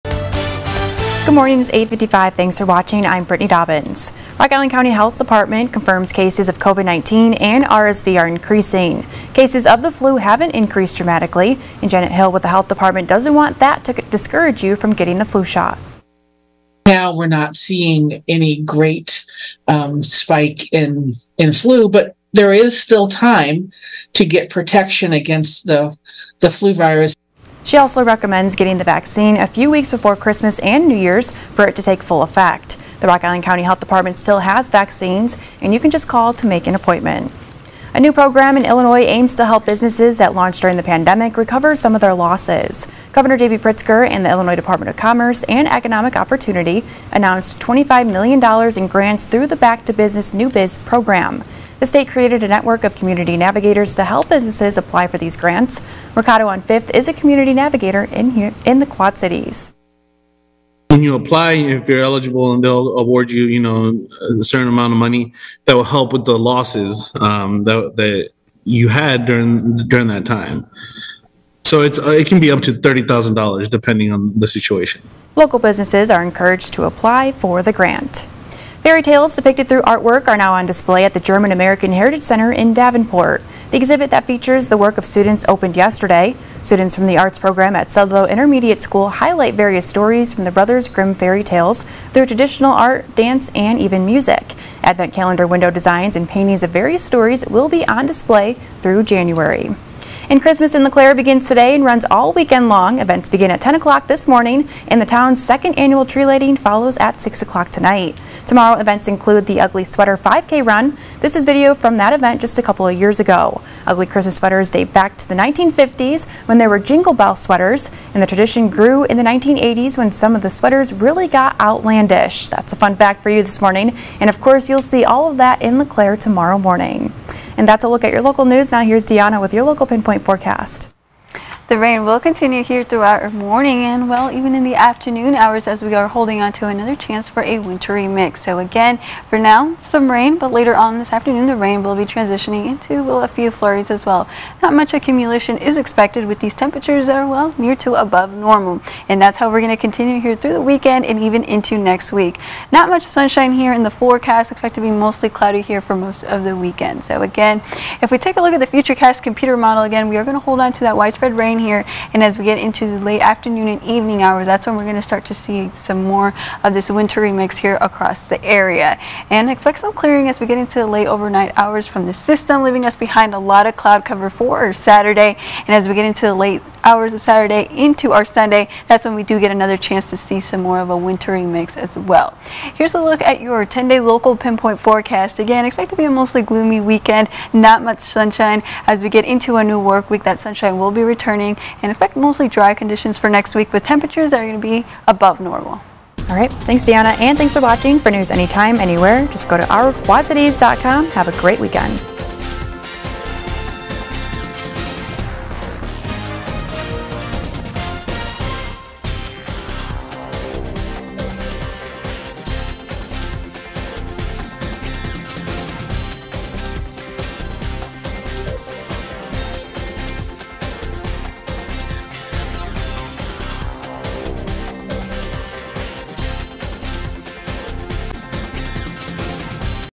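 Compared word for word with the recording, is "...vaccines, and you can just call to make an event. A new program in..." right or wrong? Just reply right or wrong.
wrong.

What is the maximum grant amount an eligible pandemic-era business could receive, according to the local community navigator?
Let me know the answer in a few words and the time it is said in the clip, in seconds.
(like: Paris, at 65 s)
$30,000, at 72 s.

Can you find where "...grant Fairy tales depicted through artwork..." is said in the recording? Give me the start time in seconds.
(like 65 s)
77 s.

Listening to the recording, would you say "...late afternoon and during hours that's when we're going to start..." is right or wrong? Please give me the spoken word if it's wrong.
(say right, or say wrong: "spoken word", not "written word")
wrong: "evening", not "during".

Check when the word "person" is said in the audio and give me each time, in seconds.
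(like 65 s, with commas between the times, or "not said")
not said.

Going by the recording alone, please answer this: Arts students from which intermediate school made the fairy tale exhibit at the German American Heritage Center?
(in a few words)
Sudlow Intermediate School.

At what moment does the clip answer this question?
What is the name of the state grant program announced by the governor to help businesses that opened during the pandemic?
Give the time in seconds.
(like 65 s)
49 s.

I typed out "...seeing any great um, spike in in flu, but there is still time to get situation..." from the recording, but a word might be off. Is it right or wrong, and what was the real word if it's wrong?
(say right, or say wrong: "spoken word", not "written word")
wrong: "protection", not "situation".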